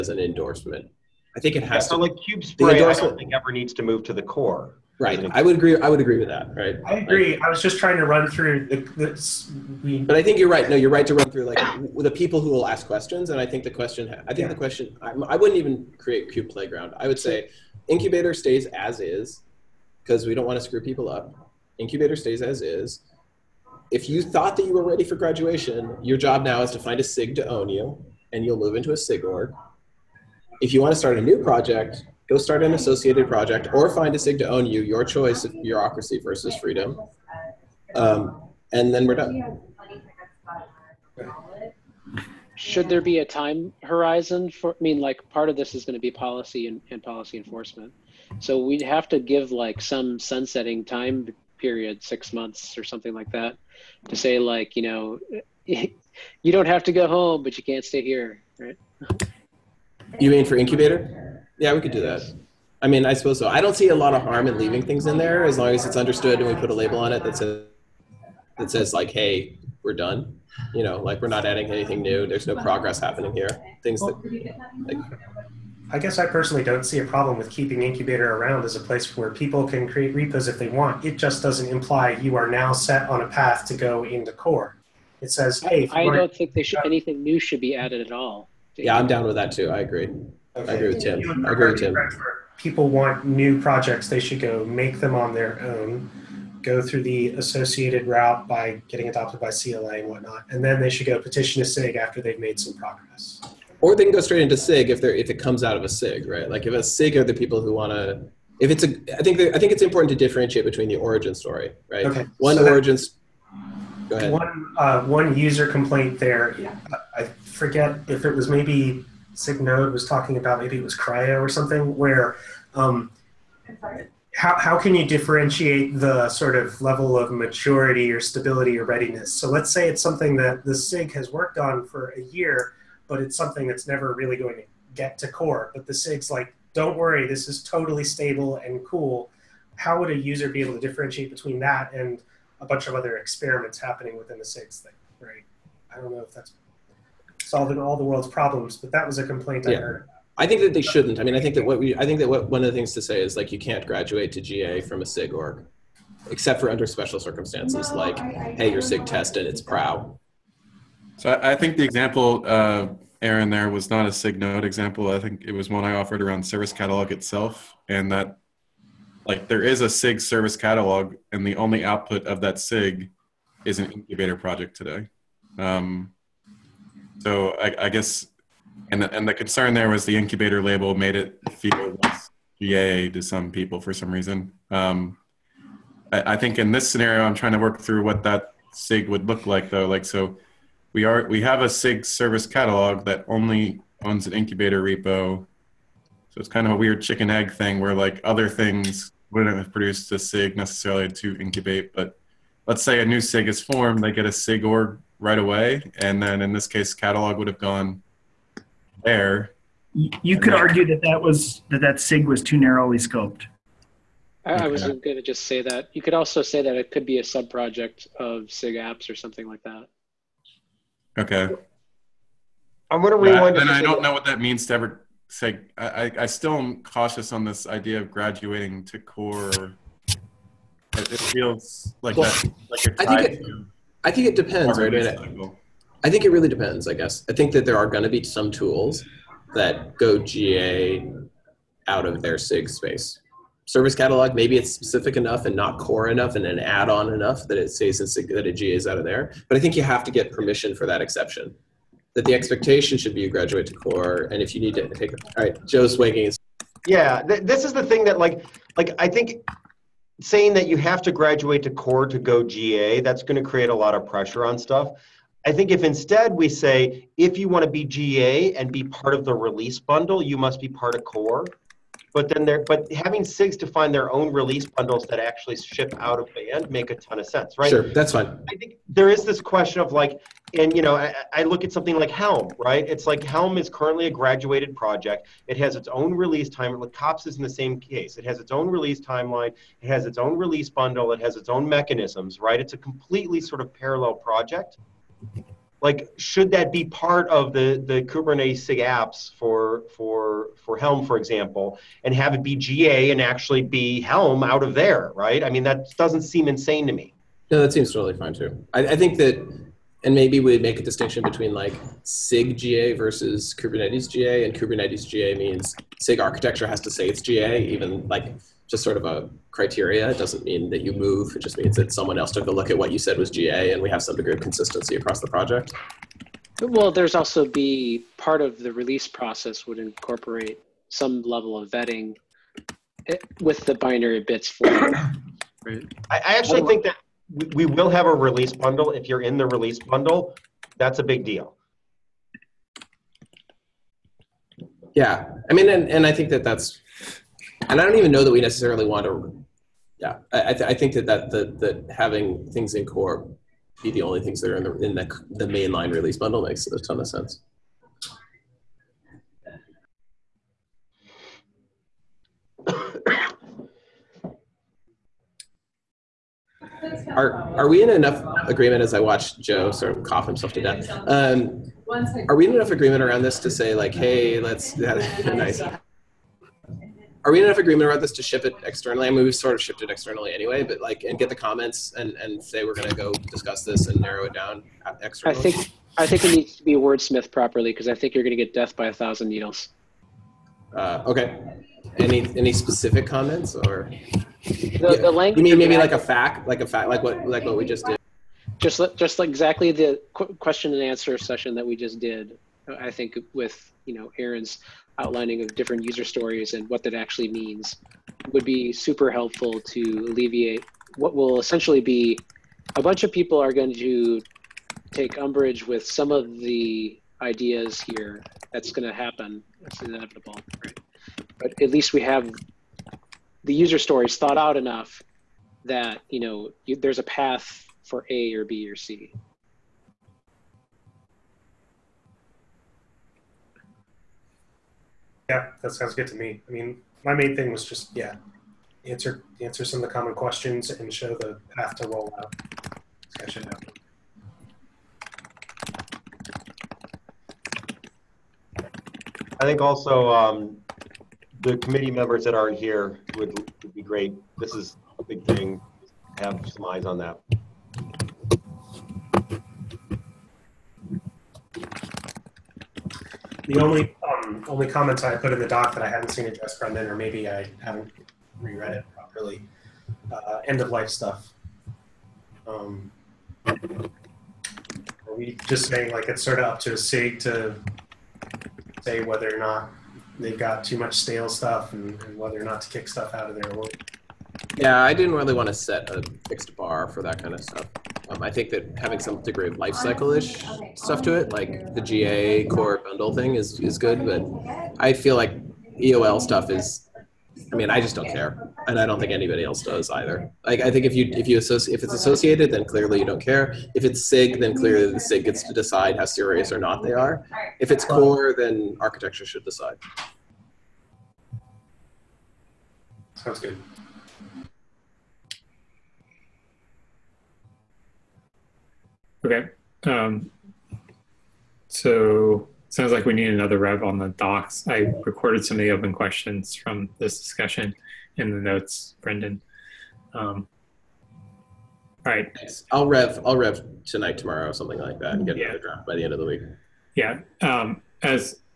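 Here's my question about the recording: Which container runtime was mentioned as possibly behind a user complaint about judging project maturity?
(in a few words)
CRI-O.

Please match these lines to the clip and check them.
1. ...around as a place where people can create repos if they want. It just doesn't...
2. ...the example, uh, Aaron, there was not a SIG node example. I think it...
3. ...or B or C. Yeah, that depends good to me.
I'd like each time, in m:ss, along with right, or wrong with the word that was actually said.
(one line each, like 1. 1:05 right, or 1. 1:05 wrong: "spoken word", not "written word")
1. 1:18 right
2. 2:41 right
3. 7:08 wrong: "sounds", not "depends".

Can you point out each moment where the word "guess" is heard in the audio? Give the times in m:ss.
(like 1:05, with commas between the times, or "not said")
1:15, 2:57, 3:56.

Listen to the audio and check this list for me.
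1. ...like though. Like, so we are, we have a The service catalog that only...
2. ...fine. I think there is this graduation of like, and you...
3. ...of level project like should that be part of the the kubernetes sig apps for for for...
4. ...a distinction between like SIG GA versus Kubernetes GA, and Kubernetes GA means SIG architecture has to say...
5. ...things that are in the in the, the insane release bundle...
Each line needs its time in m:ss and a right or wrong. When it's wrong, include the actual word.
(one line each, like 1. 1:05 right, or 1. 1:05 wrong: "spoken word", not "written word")
1. 3:09 wrong: "SIG", not "The"
2. 4:38 wrong: "question", not "graduation"
3. 4:53 wrong: "parallel", not "level"
4. 5:10 right
5. 5:54 wrong: "mainline", not "insane".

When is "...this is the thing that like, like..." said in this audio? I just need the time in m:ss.
4:17.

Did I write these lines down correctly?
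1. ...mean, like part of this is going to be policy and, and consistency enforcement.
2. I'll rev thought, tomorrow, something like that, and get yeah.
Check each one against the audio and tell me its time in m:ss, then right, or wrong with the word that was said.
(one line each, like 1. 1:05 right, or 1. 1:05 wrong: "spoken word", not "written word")
1. 0:44 wrong: "policy", not "consistency"
2. 8:53 wrong: "tonight", not "thought".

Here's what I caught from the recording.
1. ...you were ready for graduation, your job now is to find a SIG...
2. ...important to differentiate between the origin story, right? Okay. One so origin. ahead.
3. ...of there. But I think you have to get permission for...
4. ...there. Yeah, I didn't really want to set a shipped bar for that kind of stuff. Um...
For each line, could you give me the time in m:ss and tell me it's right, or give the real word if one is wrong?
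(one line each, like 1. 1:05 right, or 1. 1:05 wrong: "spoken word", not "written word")
1. 0:24 right
2. 1:49 right
3. 4:08 right
4. 8:03 wrong: "fixed", not "shipped".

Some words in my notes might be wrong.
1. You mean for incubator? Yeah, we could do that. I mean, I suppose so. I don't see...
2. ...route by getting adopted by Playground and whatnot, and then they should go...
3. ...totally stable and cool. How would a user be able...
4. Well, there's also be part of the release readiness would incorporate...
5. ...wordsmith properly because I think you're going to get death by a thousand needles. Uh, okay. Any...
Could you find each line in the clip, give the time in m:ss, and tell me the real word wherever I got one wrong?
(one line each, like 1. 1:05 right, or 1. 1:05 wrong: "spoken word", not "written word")
1. 1:00 right
2. 1:38 wrong: "CLA", not "Playground"
3. 2:17 right
4. 5:26 wrong: "process", not "readiness"
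5. 6:26 right.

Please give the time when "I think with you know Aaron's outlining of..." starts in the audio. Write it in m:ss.
6:42.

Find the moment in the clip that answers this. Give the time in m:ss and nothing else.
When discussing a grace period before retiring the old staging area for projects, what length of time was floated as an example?
0:52.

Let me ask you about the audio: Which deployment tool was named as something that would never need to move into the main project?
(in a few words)
Kubespray.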